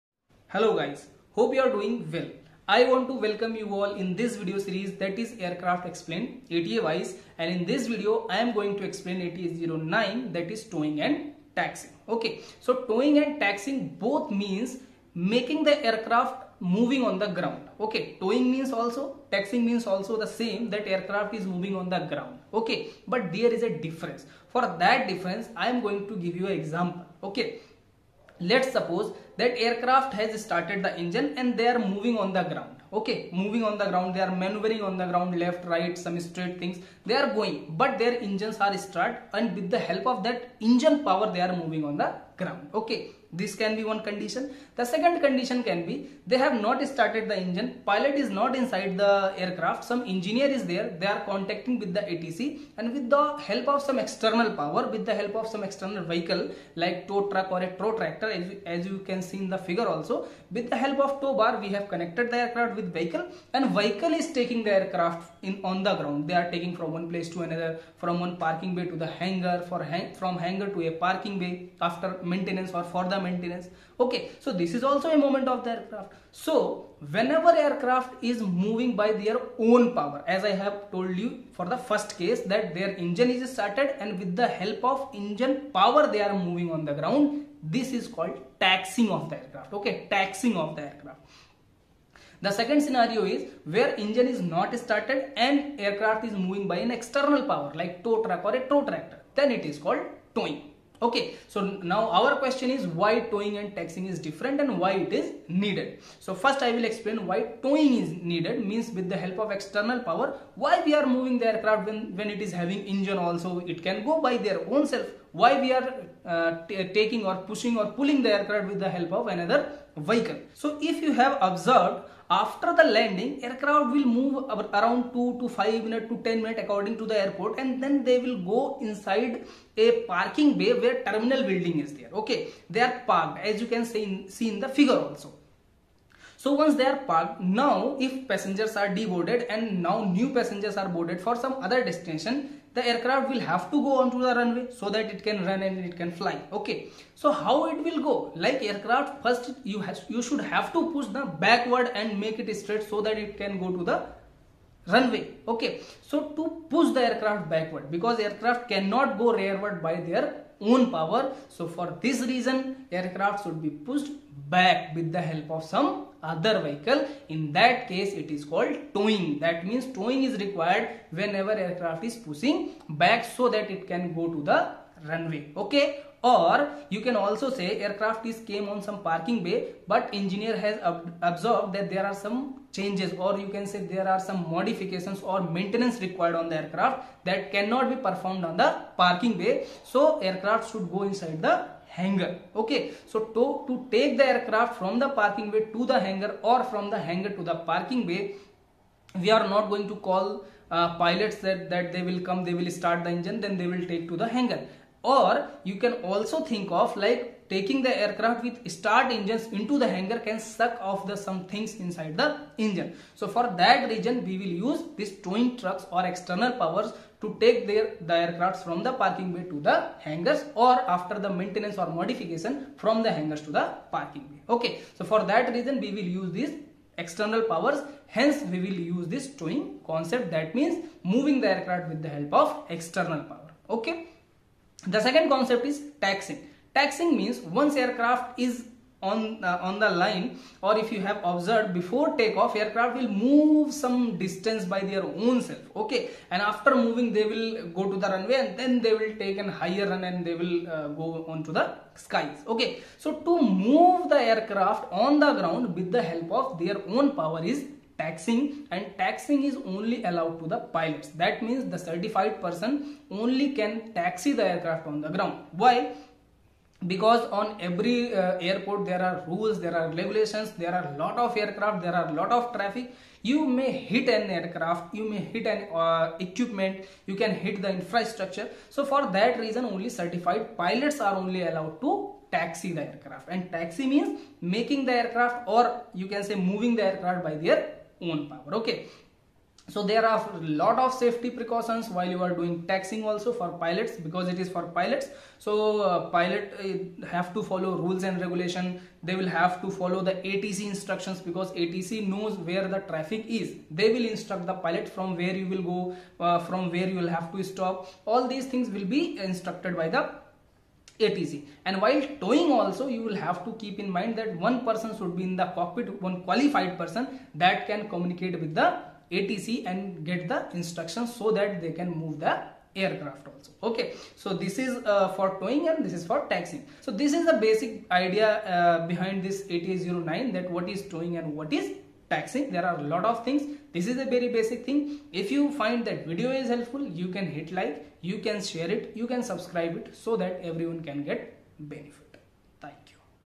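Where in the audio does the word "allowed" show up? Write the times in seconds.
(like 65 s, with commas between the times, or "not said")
260 s, 281 s.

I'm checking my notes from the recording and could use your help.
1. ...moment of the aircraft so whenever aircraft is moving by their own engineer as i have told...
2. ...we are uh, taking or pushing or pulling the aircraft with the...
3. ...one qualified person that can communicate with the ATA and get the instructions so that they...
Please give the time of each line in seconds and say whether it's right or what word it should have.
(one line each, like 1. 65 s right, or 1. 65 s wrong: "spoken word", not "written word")
1. 75 s wrong: "power", not "engineer"
2. 115 s right
3. 315 s wrong: "ATC", not "ATA".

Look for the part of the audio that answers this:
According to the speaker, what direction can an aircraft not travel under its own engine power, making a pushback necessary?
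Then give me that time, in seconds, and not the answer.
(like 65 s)
159 s.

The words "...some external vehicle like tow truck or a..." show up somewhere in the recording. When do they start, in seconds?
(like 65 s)
55 s.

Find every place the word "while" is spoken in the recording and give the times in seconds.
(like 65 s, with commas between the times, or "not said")
291 s, 311 s.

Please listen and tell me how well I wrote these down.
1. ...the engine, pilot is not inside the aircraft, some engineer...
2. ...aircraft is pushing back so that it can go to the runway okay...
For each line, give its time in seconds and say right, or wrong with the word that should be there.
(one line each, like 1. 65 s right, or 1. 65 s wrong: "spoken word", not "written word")
1. 47 s right
2. 171 s right.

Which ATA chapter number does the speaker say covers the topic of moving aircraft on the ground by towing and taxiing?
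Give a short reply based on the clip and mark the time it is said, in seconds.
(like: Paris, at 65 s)
09, at 9 s.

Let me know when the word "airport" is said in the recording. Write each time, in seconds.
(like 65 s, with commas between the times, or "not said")
127 s, 268 s.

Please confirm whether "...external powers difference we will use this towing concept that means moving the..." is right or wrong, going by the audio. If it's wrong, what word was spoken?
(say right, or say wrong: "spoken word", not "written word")
wrong: "hence", not "difference".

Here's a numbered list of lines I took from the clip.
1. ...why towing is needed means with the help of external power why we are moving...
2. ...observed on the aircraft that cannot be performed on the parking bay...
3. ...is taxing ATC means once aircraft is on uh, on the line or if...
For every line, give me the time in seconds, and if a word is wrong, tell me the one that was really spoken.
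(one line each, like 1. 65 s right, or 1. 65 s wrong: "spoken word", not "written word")
1. 107 s right
2. 186 s wrong: "required", not "observed"
3. 235 s wrong: "Taxing", not "ATC".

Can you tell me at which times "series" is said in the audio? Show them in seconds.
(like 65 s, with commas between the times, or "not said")
4 s.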